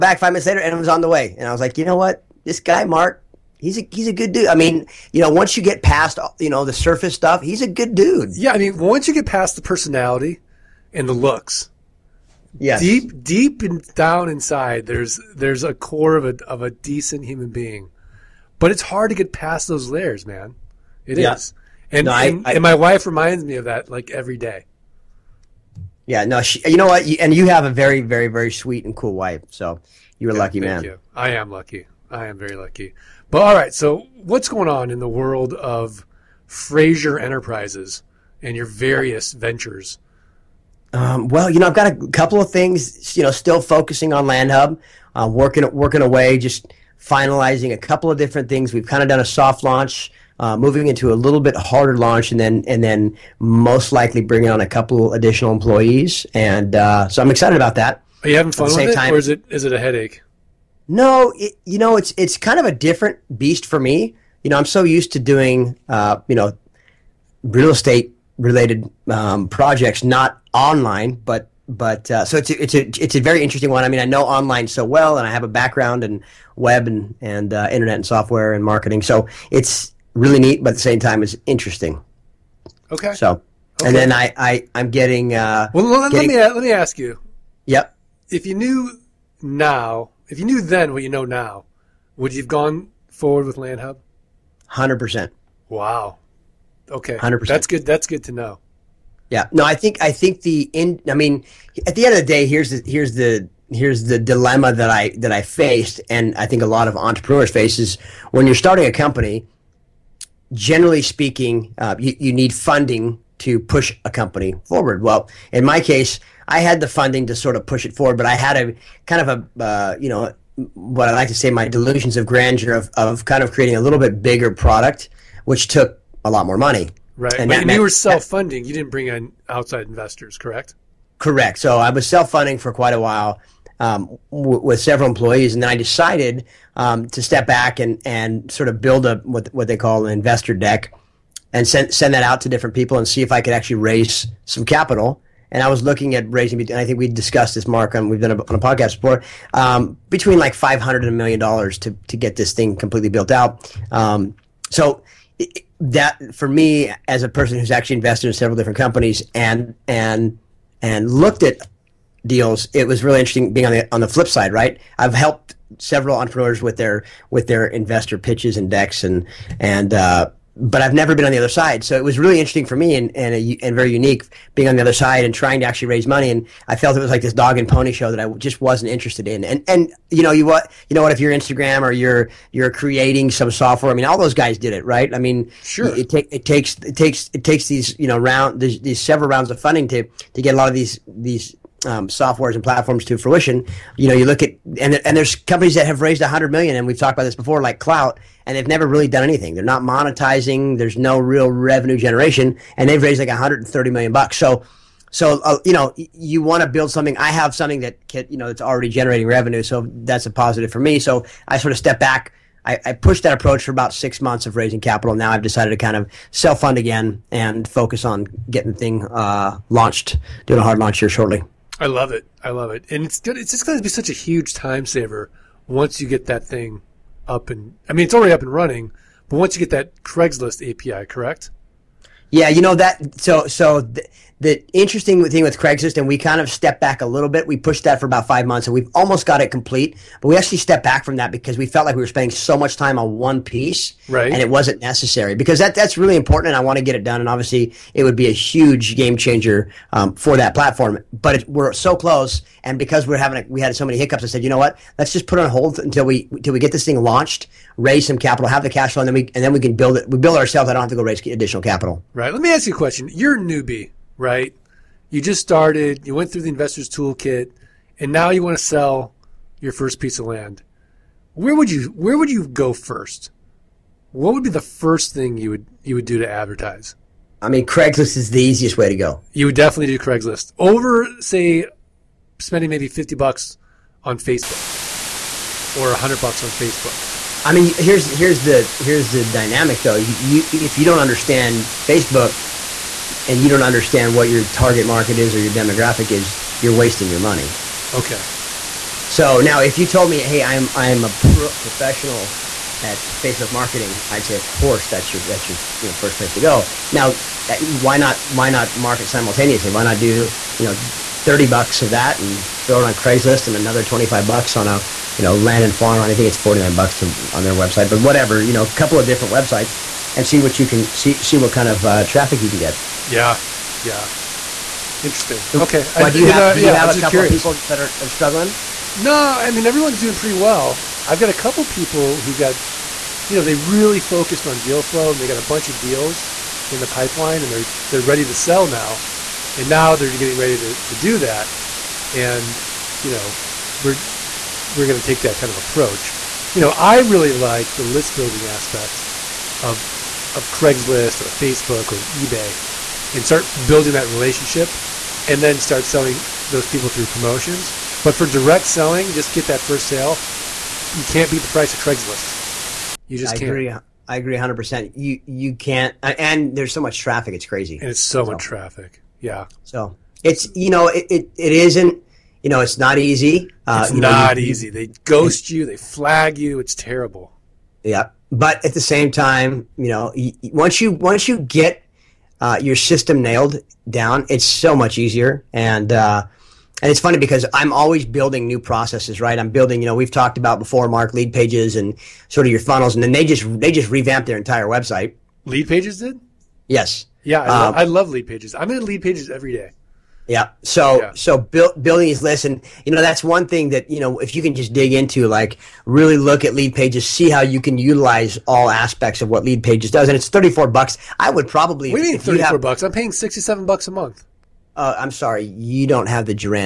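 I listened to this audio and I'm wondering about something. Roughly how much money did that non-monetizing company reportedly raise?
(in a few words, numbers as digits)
$130 million.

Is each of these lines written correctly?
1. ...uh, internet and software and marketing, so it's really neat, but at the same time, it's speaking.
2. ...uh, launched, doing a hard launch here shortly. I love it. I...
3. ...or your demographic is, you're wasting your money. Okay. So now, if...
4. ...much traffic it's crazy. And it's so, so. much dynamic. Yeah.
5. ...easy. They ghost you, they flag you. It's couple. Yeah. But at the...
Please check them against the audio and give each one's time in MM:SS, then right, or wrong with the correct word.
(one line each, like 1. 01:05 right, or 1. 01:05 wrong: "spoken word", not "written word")
1. 01:17 wrong: "interesting", not "speaking"
2. 03:39 right
3. 04:55 right
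4. 06:06 wrong: "traffic", not "dynamic"
5. 06:14 wrong: "terrible", not "couple".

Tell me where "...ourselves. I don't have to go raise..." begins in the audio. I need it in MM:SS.
04:20.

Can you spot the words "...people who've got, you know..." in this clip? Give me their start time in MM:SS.
05:31.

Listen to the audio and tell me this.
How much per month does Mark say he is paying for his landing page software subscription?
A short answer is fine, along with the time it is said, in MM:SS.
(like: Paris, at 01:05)
$67, at 06:53.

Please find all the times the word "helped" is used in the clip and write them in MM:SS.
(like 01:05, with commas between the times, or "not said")
02:45.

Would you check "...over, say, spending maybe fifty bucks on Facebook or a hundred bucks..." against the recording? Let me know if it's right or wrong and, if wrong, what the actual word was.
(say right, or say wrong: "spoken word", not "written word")
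right.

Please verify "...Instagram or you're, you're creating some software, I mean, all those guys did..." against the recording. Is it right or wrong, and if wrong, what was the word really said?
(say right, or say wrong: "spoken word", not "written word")
right.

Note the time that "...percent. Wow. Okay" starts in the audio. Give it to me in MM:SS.
01:34.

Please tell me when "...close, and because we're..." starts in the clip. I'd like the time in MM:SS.
04:11.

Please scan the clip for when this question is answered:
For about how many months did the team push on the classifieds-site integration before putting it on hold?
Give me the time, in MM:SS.
03:58.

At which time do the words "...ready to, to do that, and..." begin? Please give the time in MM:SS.
05:40.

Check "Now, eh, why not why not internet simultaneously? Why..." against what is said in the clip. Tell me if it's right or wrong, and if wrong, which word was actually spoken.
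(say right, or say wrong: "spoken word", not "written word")
wrong: "market", not "internet".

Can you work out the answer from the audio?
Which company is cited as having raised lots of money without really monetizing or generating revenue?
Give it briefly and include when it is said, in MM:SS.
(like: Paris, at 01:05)
Klout, at 03:17.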